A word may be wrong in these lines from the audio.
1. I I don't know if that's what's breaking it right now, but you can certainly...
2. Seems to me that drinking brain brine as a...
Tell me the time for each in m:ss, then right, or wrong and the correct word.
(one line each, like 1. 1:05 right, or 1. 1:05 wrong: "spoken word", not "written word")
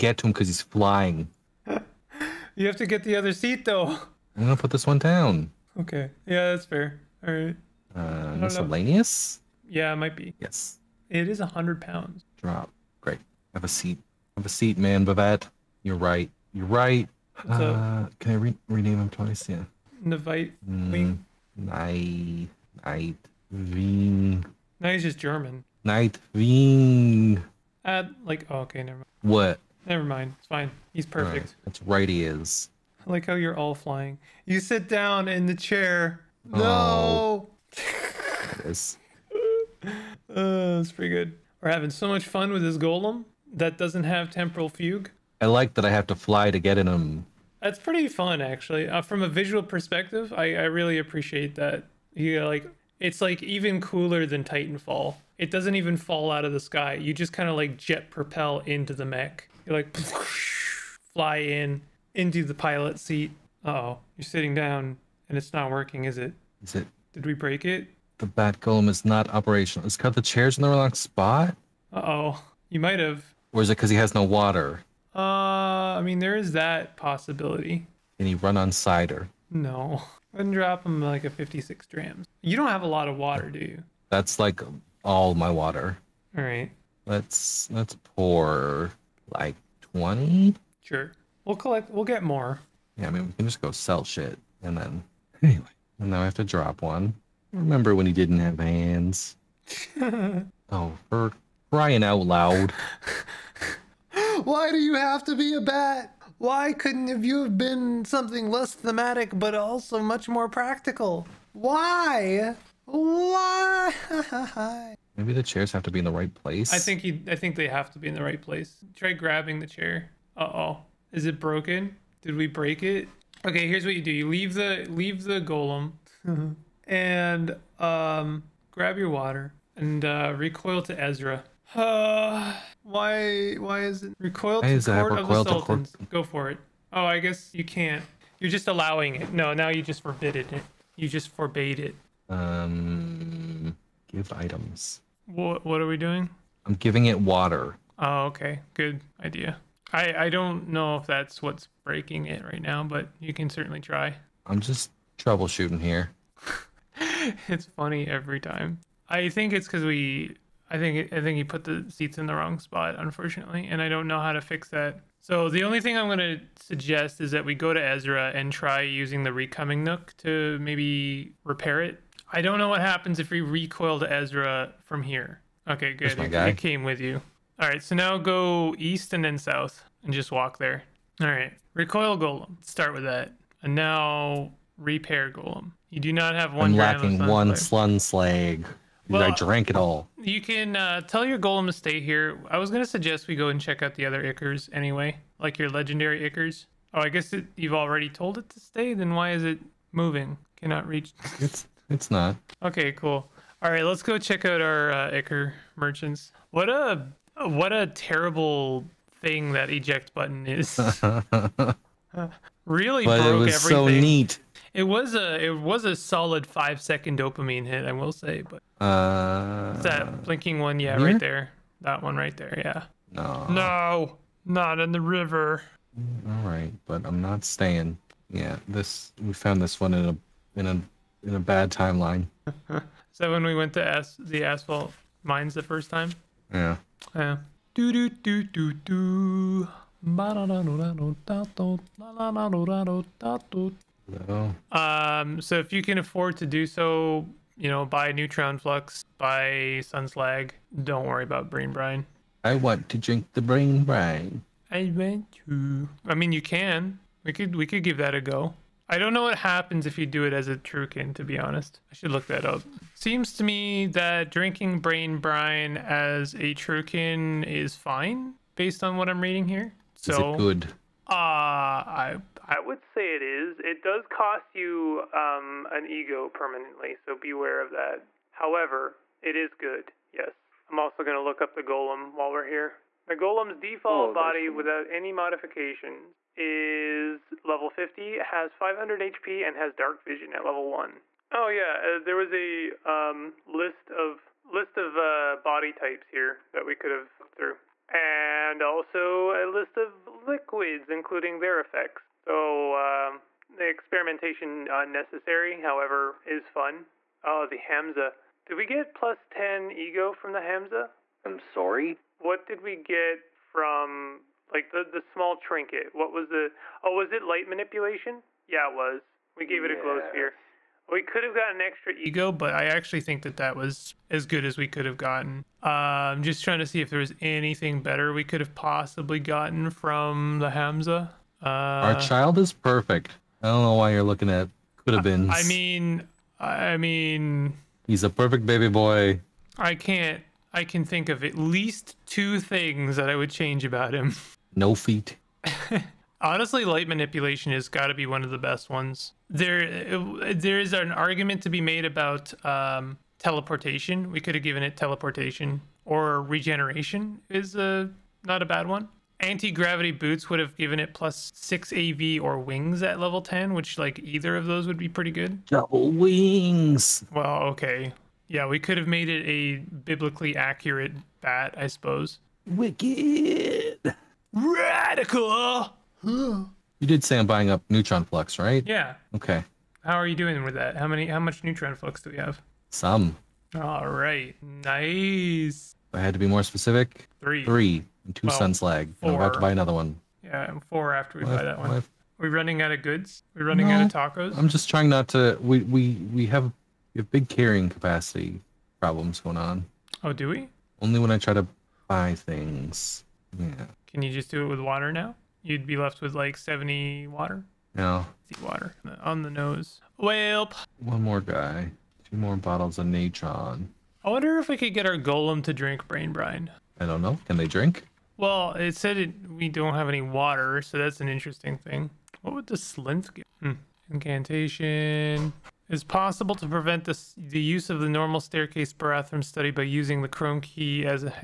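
1. 2:29 right
2. 4:22 right.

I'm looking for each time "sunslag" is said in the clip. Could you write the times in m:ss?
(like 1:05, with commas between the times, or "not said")
3:07, 4:09, 6:28.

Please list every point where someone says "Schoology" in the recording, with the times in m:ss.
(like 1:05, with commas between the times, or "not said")
not said.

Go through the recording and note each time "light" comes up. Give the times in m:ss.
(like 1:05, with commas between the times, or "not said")
5:17, 5:46.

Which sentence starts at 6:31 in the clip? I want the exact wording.
Well, are we running out of goods?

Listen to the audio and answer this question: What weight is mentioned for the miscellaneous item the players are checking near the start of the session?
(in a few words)
100 pounds.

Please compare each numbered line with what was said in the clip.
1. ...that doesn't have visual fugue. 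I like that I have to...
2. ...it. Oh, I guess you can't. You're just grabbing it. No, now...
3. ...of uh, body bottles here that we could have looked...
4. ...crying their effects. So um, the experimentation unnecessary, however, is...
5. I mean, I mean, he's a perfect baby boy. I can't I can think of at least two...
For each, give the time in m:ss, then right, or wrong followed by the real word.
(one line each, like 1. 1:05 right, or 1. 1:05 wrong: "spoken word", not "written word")
1. 0:43 wrong: "temporal", not "visual"
2. 2:16 wrong: "allowing", not "grabbing"
3. 4:54 wrong: "types", not "bottles"
4. 5:00 wrong: "including", not "crying"
5. 5:35 right.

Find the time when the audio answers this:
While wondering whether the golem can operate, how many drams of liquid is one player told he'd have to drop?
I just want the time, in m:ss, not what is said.
1:21.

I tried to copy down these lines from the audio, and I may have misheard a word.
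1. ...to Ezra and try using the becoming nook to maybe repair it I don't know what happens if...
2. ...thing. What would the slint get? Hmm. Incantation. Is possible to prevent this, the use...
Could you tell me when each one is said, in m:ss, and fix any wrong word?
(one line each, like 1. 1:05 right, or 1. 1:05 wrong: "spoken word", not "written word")
1. 2:47 right
2. 7:01 right.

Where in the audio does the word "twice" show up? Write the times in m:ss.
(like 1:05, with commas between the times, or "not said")
0:19.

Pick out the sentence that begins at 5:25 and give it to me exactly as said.
Uh, I'm just trying to see if there was anything better we could have possibly gotten from the Hamsa.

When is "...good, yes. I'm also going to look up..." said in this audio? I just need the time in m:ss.
4:39.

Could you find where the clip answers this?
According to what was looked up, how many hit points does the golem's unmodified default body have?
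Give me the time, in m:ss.
4:48.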